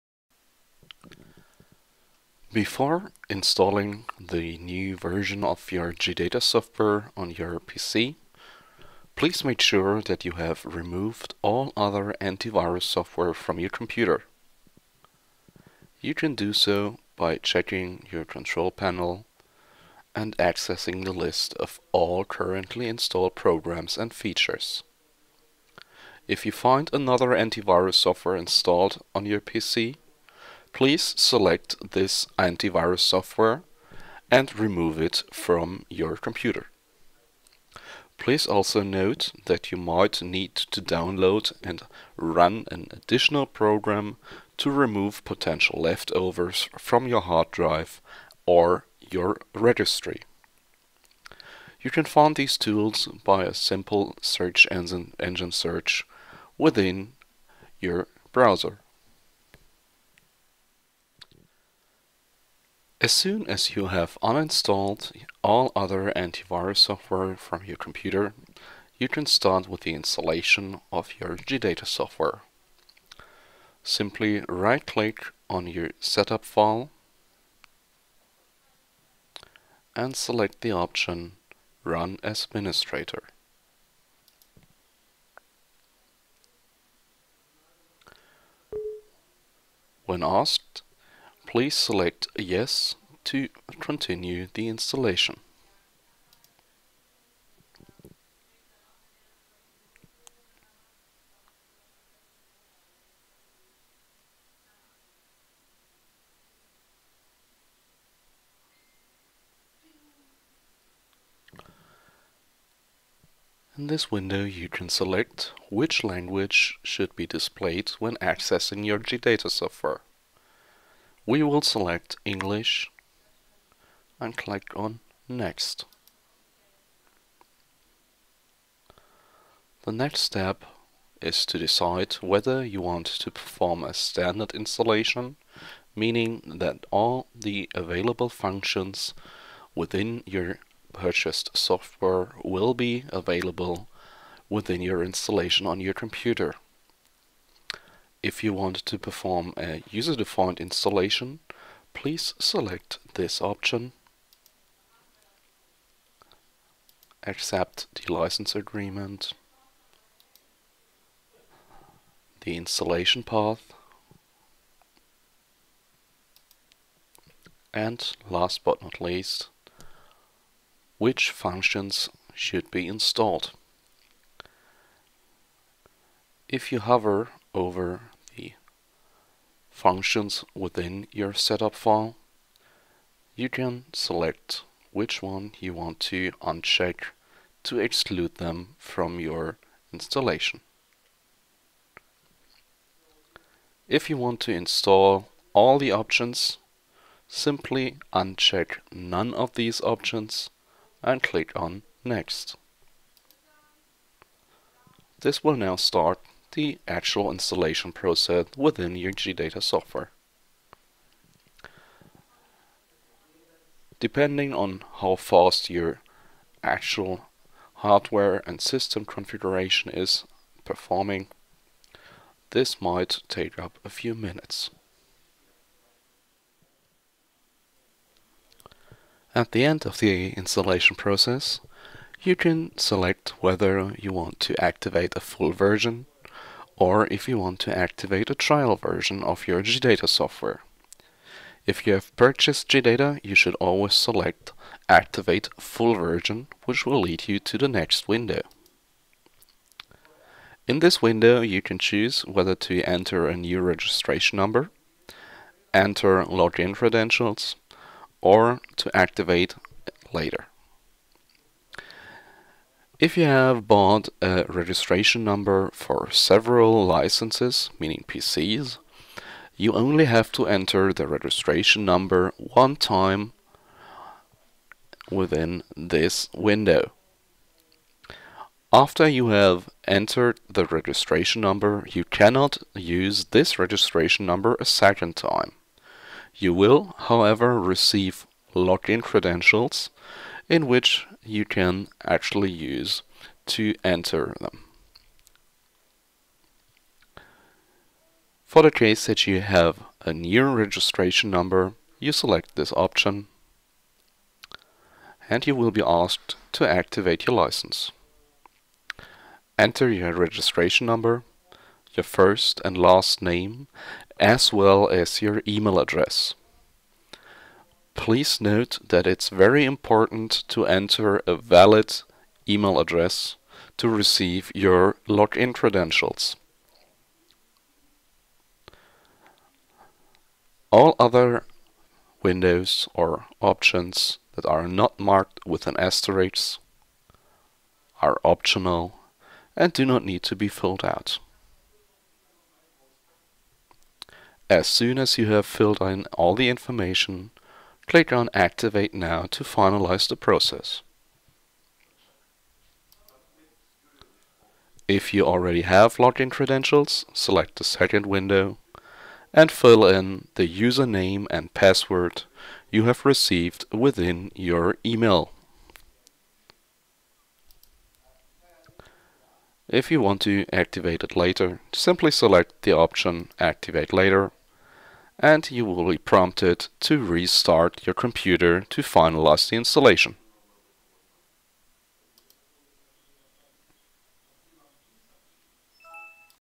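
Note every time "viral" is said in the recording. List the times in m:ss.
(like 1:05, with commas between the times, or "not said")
not said.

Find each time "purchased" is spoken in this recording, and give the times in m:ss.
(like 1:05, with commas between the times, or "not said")
2:20, 4:02.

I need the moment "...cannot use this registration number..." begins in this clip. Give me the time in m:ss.
4:42.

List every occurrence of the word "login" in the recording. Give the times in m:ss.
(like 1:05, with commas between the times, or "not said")
4:16, 4:48, 5:25, 5:55.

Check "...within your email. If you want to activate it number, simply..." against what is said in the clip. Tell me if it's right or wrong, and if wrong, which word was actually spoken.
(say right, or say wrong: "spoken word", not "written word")
wrong: "later", not "number".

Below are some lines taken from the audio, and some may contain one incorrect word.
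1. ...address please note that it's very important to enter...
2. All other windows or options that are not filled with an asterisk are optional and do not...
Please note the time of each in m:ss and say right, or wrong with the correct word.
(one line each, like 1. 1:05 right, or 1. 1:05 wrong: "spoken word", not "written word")
1. 5:15 right
2. 5:30 wrong: "marked", not "filled".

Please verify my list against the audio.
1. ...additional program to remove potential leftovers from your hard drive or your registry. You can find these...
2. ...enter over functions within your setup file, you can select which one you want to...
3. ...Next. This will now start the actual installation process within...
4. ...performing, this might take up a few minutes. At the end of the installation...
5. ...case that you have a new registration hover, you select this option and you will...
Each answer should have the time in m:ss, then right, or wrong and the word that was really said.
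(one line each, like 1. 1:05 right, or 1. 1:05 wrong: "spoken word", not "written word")
1. 0:42 right
2. 2:56 wrong: "hover", not "enter"
3. 3:22 right
4. 3:40 right
5. 4:58 wrong: "number", not "hover".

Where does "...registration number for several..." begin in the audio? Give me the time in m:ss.
4:24.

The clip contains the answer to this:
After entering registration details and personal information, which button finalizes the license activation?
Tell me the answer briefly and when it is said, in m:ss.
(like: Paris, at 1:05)
Activate Now, at 5:48.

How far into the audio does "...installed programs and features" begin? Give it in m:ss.
0:22.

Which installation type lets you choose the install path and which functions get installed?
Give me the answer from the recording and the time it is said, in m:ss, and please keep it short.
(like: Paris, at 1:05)
user-defined installation, at 2:29.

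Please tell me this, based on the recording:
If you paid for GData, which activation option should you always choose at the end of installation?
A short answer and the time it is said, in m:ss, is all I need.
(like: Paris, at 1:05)
Activate Full Version, at 4:04.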